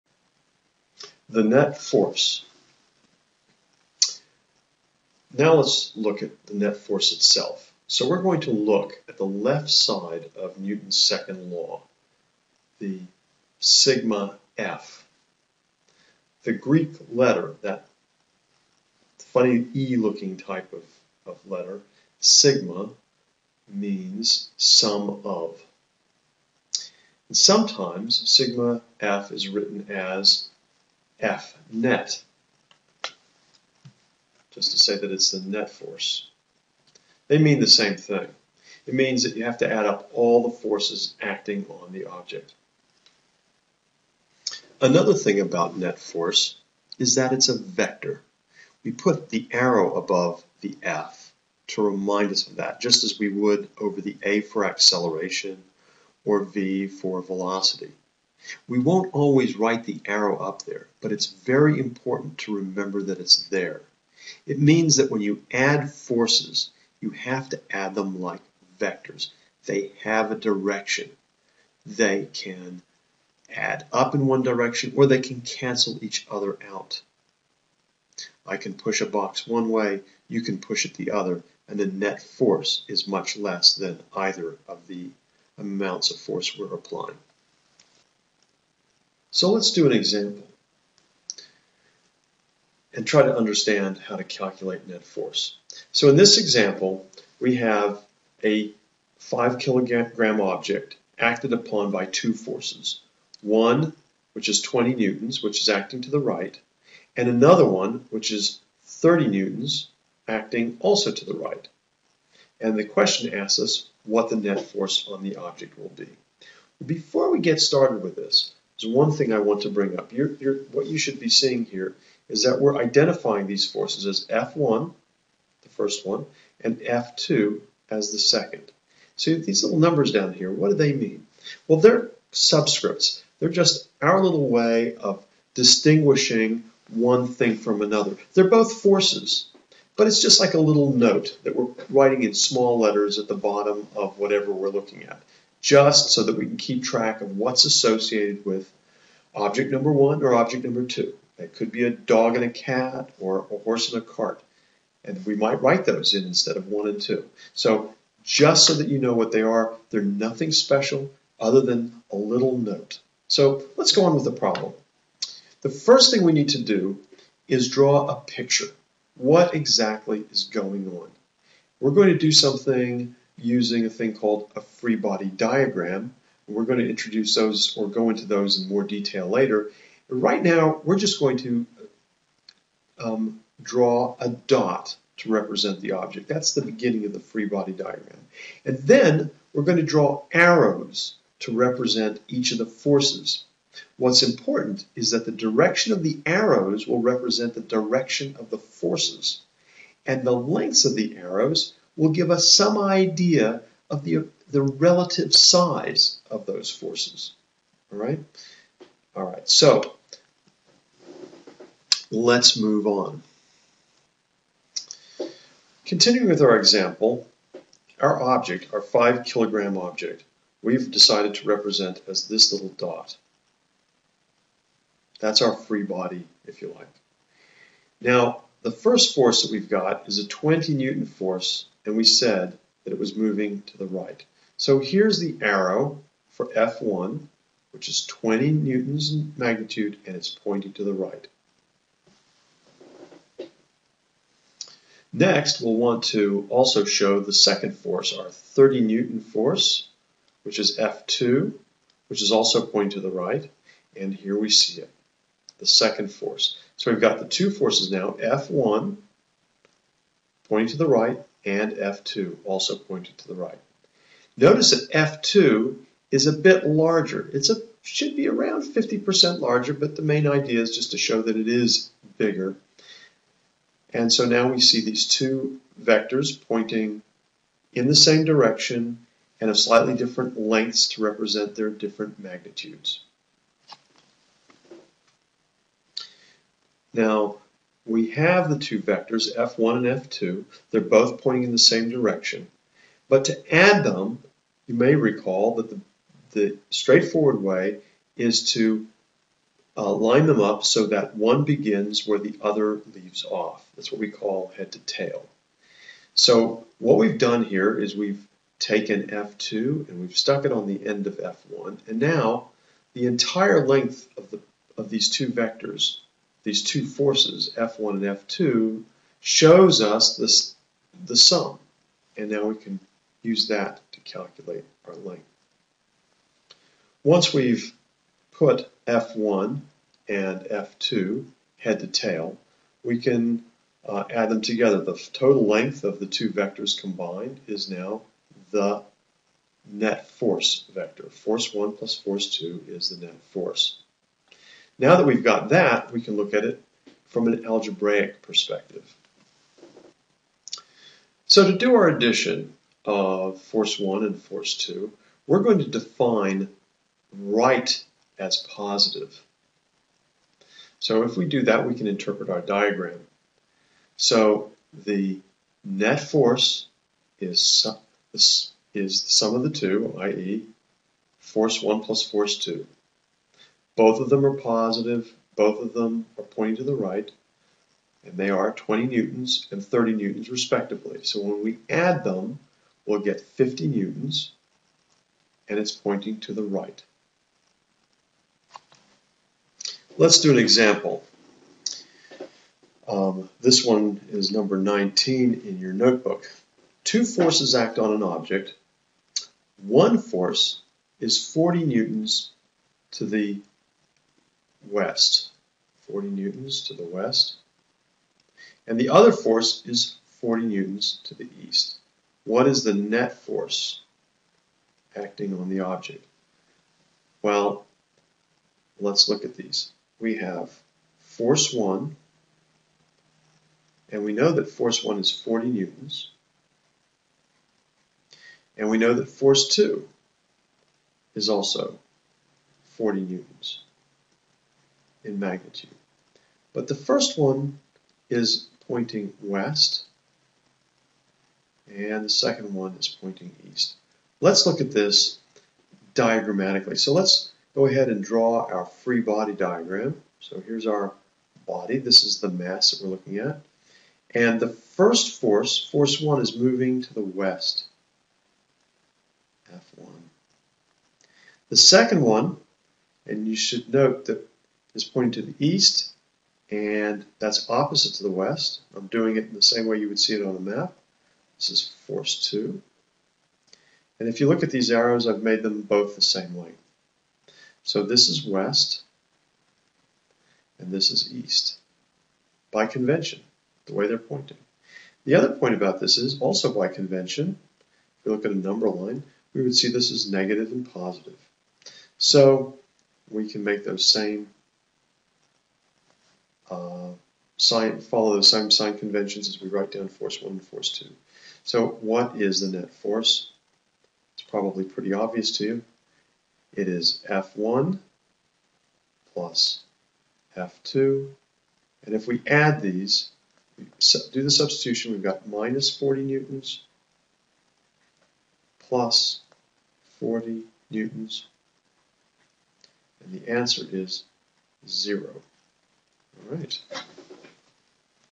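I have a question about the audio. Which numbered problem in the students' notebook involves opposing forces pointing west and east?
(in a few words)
19.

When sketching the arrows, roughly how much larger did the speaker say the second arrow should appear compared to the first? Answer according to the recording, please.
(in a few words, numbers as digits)
50% larger.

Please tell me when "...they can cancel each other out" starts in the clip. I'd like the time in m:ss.
1:15.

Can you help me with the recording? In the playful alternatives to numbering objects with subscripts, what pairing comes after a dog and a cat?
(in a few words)
a horse and a cart.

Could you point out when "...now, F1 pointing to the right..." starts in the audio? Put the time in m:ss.
4:17.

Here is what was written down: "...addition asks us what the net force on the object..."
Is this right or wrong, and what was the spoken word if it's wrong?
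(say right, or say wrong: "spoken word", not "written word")
wrong: "question", not "addition".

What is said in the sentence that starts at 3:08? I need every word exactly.
And then we're going to draw arrows to represent each of the forces.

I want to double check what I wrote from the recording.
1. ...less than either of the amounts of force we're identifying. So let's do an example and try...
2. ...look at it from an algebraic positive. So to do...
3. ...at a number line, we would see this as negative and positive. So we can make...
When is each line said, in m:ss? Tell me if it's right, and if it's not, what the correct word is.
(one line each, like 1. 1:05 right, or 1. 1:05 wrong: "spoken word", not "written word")
1. 1:23 wrong: "applying", not "identifying"
2. 5:46 wrong: "perspective", not "positive"
3. 8:08 right.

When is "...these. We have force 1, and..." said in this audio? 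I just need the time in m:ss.
6:59.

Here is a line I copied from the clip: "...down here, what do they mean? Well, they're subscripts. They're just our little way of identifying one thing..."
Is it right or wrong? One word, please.
wrong.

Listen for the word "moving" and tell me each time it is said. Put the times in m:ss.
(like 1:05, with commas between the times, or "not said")
3:53, 7:36.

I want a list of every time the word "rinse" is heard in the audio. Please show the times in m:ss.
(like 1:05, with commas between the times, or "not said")
not said.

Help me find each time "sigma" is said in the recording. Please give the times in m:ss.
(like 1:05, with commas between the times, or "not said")
0:13, 0:22, 0:28.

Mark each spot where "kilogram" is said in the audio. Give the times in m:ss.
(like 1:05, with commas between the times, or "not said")
1:39, 3:39.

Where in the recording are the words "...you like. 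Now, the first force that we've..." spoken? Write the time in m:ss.
3:46.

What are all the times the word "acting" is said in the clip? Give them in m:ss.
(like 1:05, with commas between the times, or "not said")
0:41, 1:45, 1:50, 6:54.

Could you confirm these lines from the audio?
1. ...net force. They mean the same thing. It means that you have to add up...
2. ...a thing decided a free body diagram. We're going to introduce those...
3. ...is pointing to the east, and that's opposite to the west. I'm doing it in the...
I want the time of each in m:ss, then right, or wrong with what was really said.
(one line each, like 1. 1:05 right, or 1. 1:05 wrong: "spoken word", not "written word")
1. 0:35 right
2. 2:53 wrong: "called", not "decided"
3. 7:44 right.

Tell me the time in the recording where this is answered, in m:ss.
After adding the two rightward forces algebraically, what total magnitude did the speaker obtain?
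6:23.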